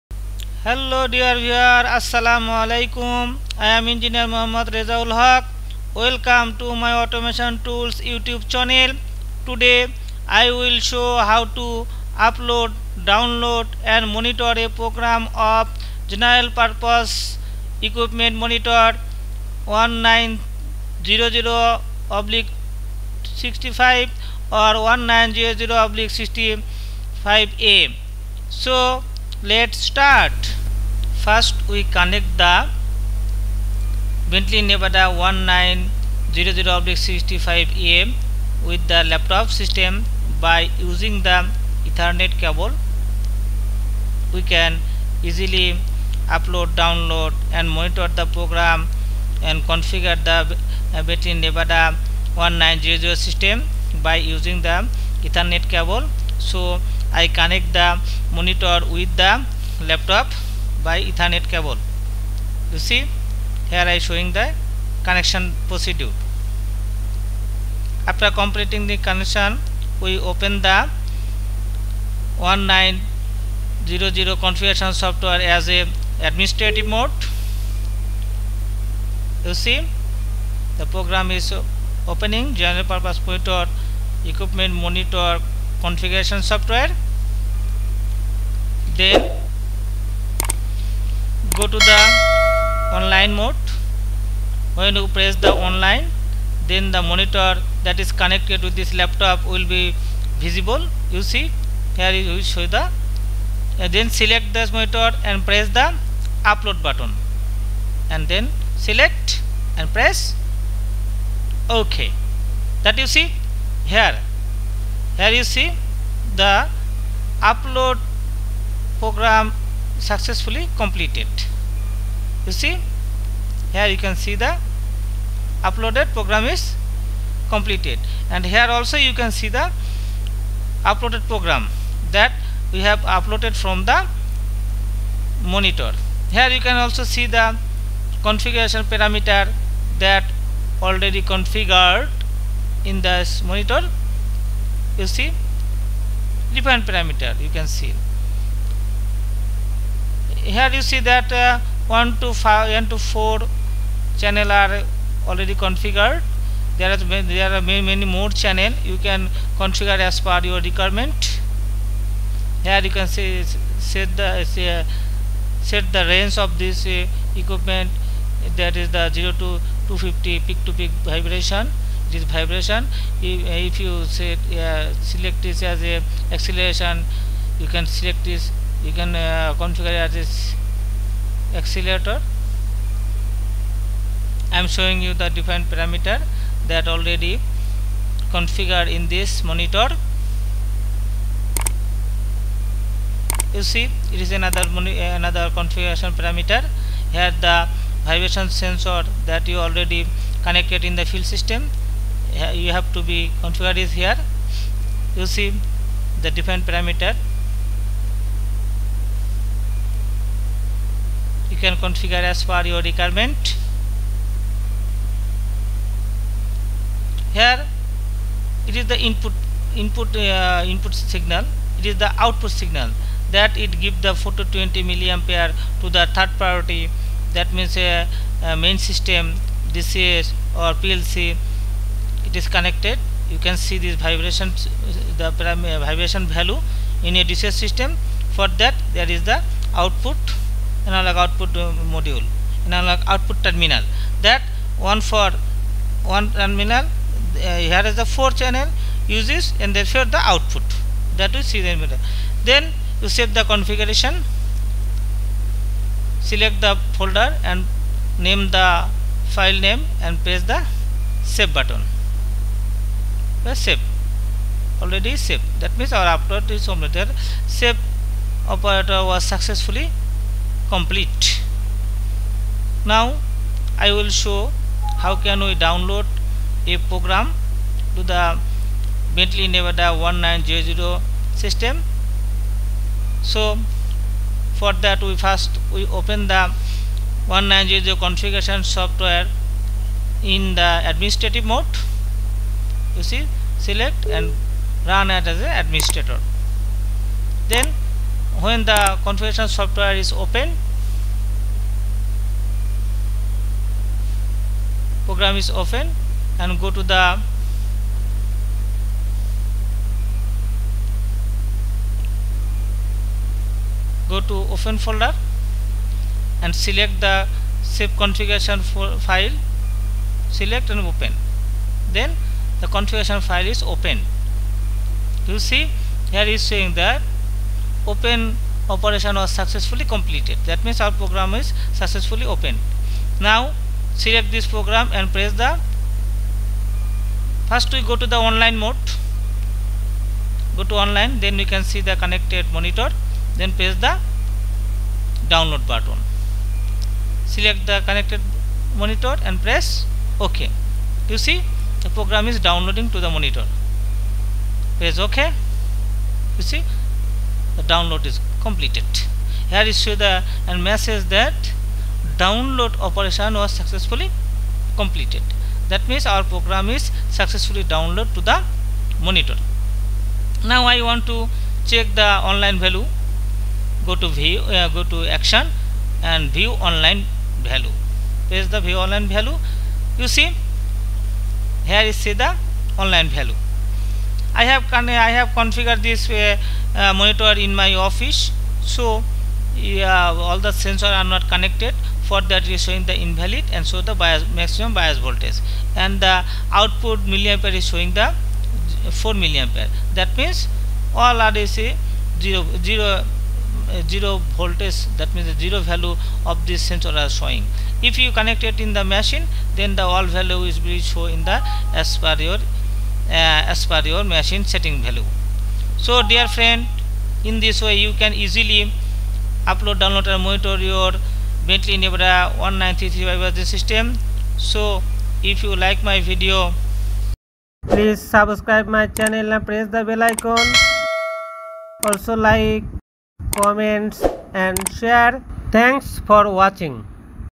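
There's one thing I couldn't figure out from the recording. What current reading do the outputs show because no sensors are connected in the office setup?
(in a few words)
4 milliampere.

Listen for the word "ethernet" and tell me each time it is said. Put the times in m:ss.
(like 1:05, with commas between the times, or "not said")
0:41, 0:55, 1:01.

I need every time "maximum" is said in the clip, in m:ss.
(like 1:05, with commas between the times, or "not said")
6:34.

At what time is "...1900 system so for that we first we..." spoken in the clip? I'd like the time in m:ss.
4:40.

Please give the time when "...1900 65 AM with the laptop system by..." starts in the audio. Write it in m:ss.
0:35.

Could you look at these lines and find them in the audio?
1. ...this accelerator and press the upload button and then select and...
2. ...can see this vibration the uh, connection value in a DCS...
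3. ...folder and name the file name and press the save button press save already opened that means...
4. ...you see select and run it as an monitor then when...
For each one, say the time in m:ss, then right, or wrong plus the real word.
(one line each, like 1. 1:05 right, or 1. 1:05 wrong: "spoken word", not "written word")
1. 1:44 wrong: "monitor", not "accelerator"
2. 3:53 wrong: "vibration", not "connection"
3. 4:16 wrong: "saved", not "opened"
4. 4:52 wrong: "administrator", not "monitor".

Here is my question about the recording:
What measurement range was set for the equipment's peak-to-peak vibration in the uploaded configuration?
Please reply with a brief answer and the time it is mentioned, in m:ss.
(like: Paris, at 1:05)
0 to 250, at 2:49.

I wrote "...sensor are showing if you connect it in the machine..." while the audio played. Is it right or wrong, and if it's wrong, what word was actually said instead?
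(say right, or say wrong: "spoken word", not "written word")
right.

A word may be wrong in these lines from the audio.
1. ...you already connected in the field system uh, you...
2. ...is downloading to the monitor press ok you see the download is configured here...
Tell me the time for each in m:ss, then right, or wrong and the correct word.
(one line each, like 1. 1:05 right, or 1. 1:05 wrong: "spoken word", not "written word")
1. 3:19 right
2. 5:52 wrong: "completed", not "configured".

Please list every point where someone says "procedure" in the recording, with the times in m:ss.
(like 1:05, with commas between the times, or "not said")
1:05.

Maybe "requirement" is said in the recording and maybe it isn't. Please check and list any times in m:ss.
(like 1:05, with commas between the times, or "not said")
2:40, 3:32.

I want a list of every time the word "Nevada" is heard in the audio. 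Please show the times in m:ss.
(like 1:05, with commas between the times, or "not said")
0:34, 0:51, 4:39, 7:01.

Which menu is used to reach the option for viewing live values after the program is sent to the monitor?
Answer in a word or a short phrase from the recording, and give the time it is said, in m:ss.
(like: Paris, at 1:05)
action, at 6:15.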